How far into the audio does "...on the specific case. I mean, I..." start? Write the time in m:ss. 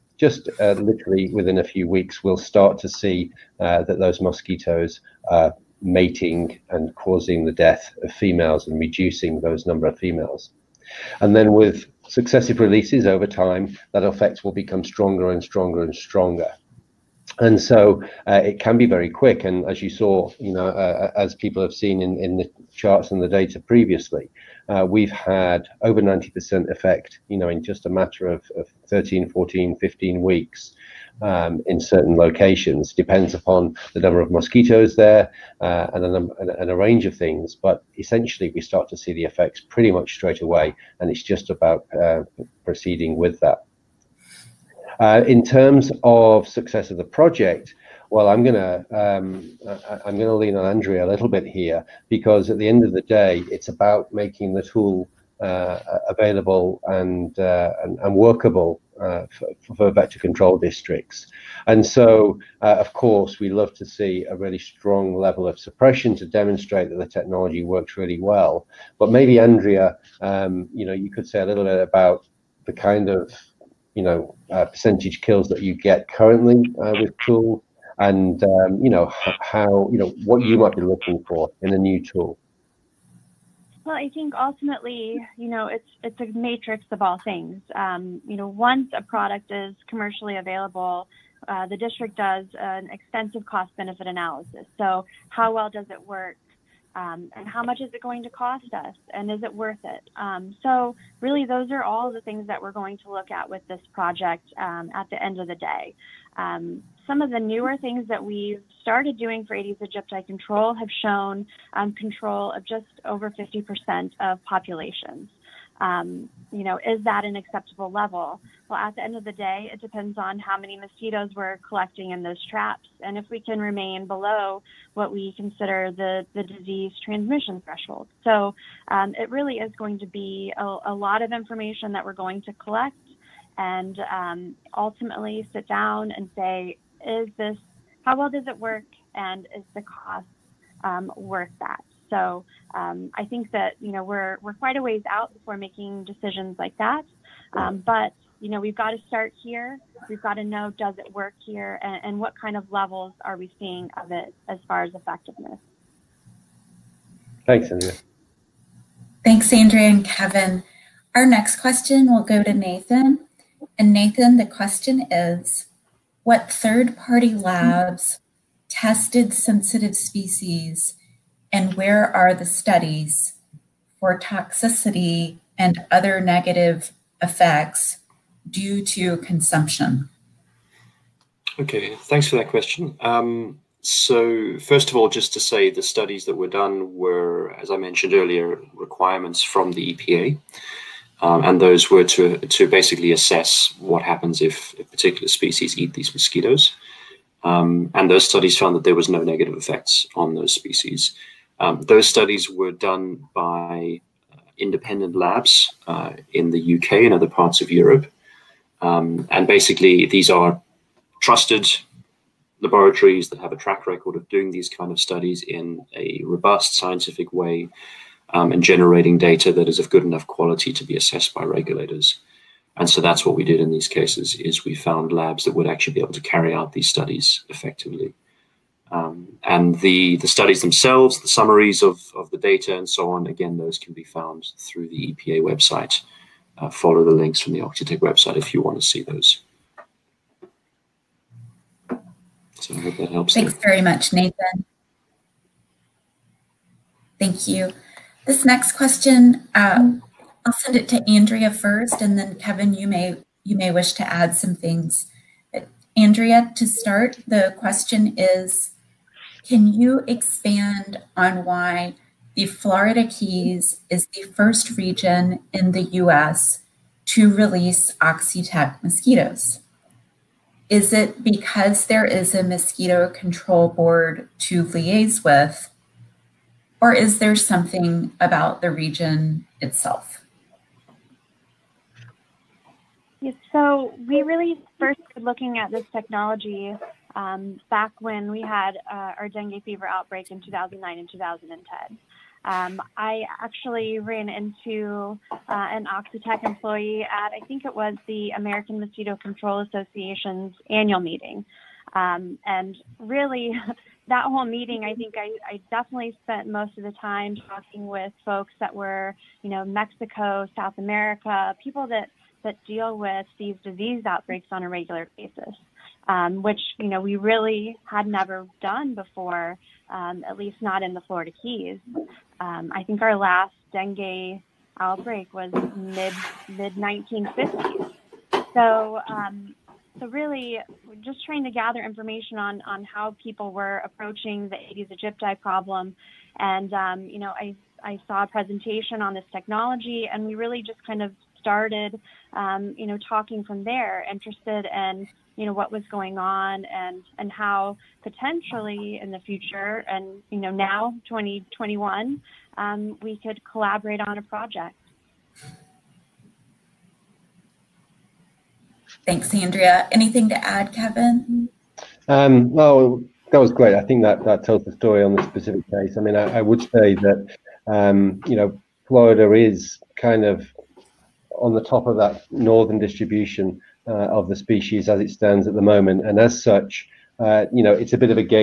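6:05.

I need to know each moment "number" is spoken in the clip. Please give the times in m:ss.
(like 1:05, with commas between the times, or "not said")
0:09, 0:33.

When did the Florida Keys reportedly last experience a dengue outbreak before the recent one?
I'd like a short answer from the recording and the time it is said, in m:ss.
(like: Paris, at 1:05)
mid 1950s, at 5:26.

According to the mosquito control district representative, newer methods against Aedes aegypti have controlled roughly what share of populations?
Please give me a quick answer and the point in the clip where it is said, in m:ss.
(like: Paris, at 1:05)
just over 50%, at 1:52.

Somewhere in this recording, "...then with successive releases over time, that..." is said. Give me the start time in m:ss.
0:11.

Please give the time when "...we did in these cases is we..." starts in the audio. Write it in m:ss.
3:43.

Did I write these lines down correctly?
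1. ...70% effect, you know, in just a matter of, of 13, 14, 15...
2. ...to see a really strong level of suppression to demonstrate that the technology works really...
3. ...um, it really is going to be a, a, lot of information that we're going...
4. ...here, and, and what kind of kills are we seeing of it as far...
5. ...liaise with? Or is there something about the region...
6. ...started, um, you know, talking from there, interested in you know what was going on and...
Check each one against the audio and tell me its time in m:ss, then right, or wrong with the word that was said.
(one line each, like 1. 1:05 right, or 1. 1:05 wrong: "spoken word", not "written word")
1. 0:26 wrong: "90", not "70"
2. 1:03 right
3. 2:08 right
4. 2:31 wrong: "levels", not "kills"
5. 4:34 right
6. 5:41 right.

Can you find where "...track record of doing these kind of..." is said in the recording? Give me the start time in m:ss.
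3:33.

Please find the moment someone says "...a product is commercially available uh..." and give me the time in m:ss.
1:28.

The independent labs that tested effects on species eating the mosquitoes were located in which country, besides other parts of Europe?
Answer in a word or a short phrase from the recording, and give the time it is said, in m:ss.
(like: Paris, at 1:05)
UK, at 3:26.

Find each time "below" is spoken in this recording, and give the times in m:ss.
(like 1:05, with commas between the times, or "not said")
2:04.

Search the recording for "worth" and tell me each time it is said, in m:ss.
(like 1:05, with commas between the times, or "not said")
1:39, 2:21.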